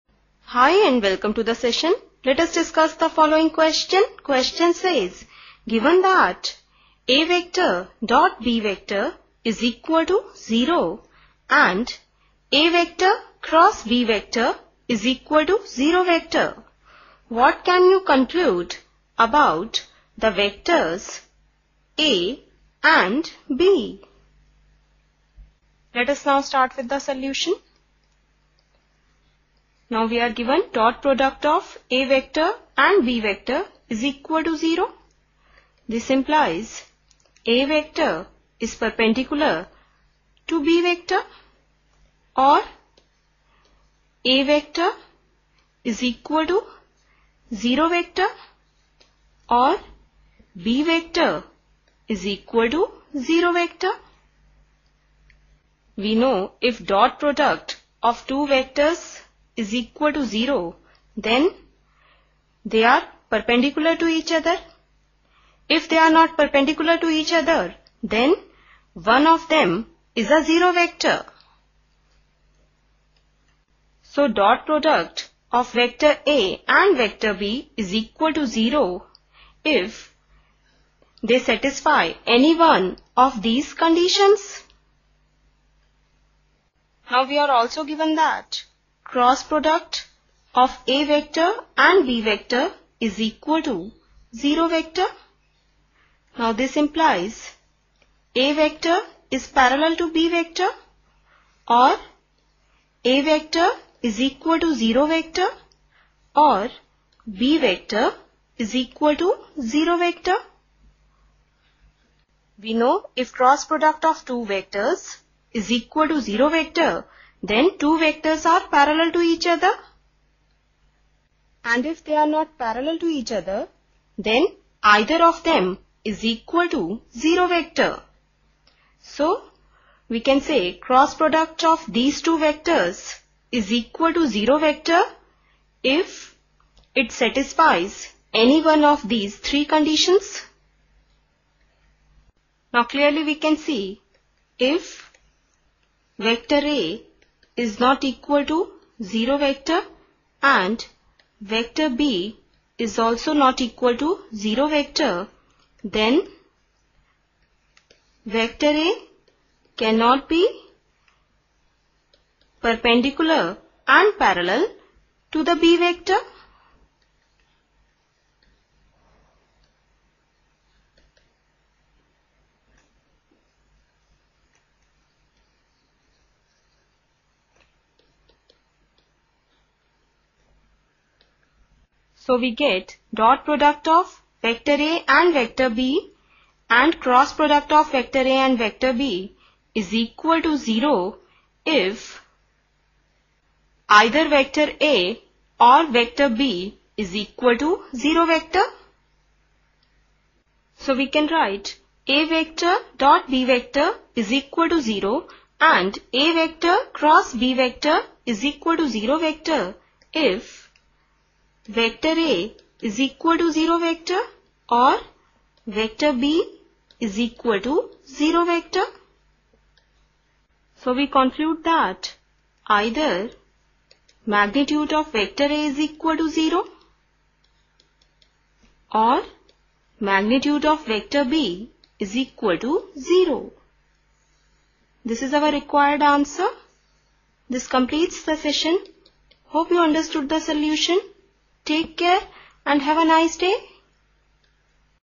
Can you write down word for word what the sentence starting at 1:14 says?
So dot product of vector A and vector B is equal to 0 if they satisfy any one of these conditions.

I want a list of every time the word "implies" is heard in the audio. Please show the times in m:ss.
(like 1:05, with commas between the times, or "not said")
0:36, 1:36.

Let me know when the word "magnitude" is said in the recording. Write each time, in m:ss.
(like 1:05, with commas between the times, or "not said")
3:44, 3:50.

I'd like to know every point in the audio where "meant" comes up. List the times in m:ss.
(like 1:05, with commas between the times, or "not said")
not said.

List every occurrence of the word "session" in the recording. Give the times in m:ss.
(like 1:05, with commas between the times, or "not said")
0:01, 3:58.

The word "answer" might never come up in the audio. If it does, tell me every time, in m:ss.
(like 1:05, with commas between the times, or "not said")
3:56.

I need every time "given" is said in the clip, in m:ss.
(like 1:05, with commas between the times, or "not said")
0:05, 0:30, 1:27.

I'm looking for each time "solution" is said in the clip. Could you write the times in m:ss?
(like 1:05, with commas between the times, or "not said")
0:26, 4:00.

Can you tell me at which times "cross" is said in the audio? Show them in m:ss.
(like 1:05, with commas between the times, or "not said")
0:13, 1:29, 1:53, 2:10, 3:07, 3:27.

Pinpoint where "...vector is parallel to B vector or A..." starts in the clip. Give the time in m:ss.
1:38.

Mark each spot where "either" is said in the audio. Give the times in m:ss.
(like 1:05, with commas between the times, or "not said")
2:04, 3:14, 3:42.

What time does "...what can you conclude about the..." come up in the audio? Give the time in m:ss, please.
0:17.